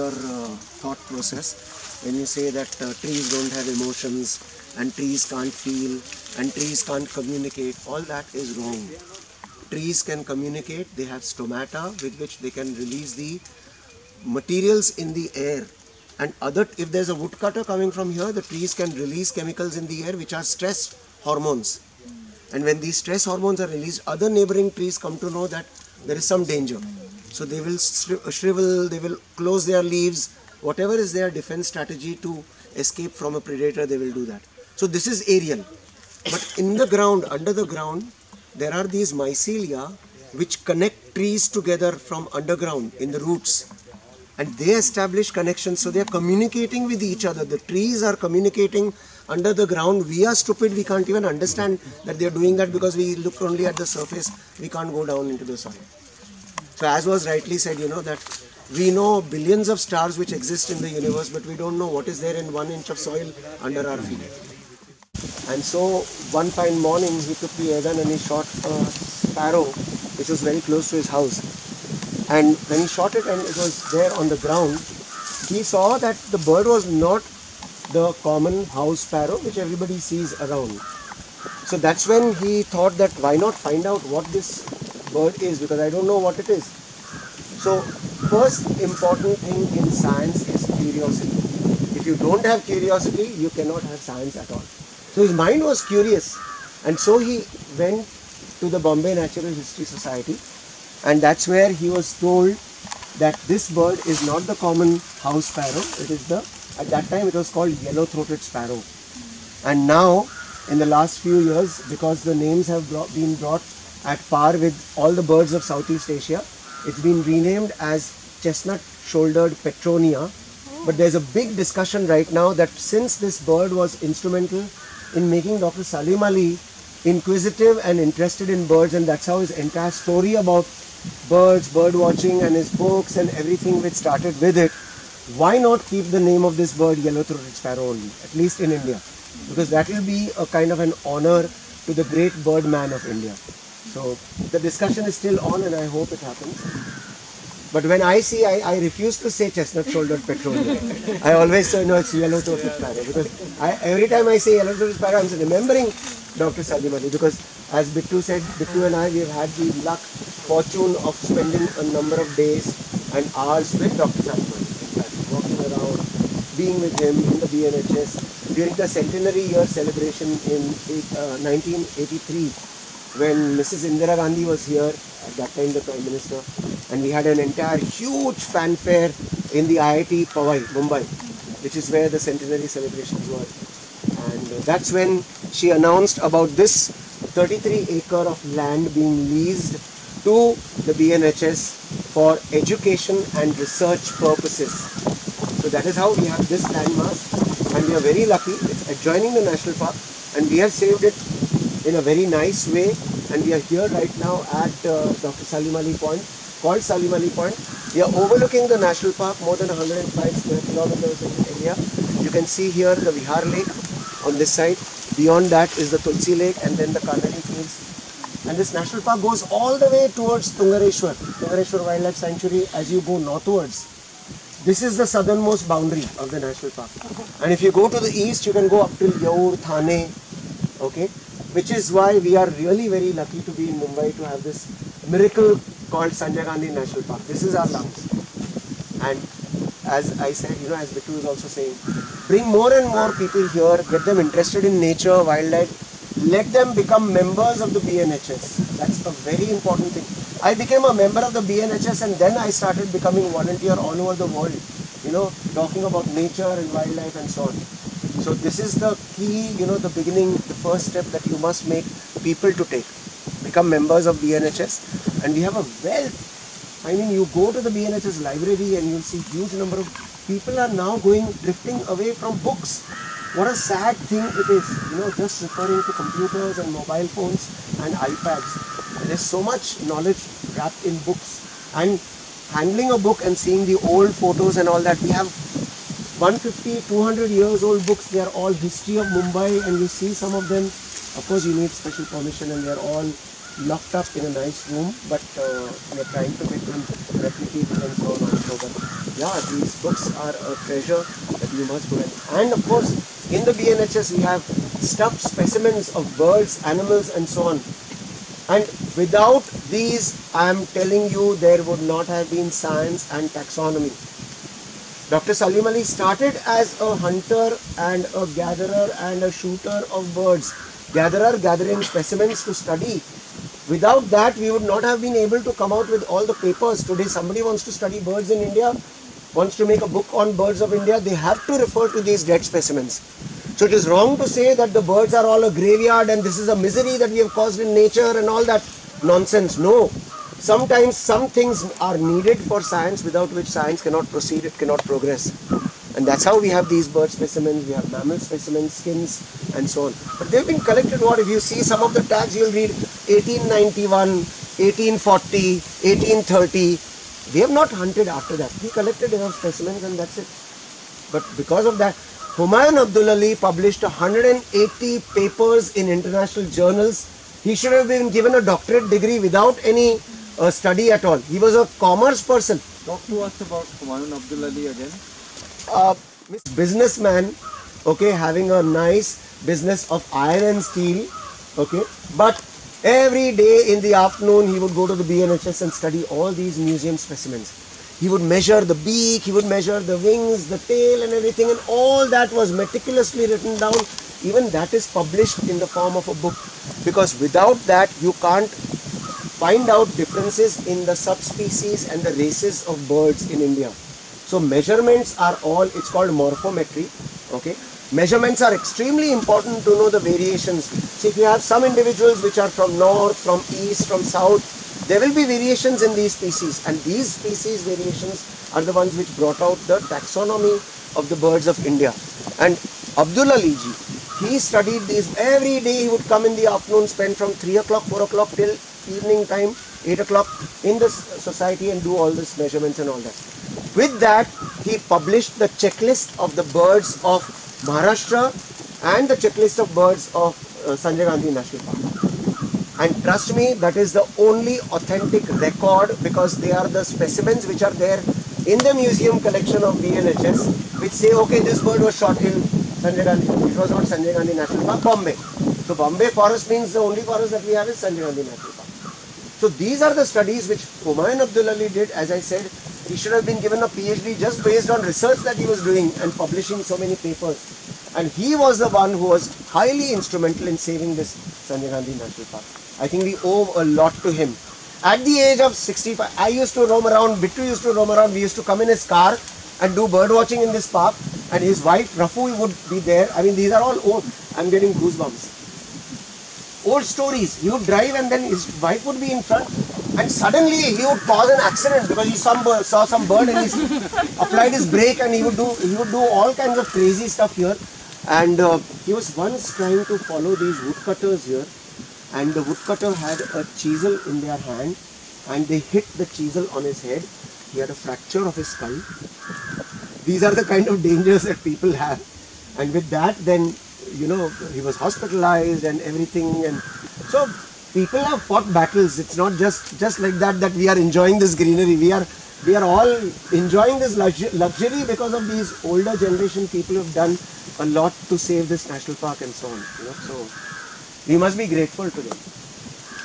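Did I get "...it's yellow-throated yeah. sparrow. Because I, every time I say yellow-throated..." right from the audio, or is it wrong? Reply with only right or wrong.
right.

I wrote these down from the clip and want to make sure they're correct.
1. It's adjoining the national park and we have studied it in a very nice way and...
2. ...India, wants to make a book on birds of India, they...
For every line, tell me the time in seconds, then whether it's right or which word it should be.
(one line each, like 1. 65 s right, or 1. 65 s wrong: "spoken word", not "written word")
1. 198 s wrong: "saved", not "studied"
2. 328 s right.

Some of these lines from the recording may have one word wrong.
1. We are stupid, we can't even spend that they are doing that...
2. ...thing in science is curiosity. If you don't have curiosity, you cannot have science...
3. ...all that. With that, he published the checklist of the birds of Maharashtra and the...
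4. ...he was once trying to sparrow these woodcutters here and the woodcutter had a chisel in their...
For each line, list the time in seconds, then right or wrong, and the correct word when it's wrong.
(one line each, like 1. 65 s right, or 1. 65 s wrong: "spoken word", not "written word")
1. 50 s wrong: "understand", not "spend"
2. 89 s right
3. 432 s right
4. 498 s wrong: "follow", not "sparrow".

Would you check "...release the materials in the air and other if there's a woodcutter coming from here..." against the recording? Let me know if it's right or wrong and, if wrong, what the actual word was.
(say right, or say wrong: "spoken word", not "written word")
right.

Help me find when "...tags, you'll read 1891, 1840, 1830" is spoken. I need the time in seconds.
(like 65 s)
352 s.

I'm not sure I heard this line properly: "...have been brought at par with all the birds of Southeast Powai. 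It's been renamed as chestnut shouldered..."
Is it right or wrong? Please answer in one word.
wrong.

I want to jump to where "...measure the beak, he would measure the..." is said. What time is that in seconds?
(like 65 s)
388 s.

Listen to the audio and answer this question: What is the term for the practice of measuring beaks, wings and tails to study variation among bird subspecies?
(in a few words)
morphometry.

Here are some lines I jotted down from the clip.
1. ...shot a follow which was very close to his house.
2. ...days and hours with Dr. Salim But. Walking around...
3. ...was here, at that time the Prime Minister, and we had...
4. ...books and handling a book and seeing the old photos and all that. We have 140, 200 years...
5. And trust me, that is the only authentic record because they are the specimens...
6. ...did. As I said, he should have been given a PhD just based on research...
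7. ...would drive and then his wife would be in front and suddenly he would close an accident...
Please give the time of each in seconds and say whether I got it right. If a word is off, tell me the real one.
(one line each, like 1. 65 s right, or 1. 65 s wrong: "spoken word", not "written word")
1. 68 s wrong: "sparrow", not "follow"
2. 162 s wrong: "Ali", not "But"
3. 174 s right
4. 281 s wrong: "150", not "140"
5. 442 s right
6. 461 s right
7. 487 s wrong: "cause", not "close".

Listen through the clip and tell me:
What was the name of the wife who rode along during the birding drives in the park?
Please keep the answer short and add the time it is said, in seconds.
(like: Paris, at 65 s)
Rafu, at 481 s.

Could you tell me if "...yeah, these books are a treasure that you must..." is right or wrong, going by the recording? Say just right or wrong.
right.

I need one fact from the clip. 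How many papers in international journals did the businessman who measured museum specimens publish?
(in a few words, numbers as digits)
180.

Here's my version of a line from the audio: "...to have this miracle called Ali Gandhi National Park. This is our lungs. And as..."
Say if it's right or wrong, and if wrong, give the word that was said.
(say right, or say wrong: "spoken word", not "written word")
wrong: "Sanjay", not "Ali".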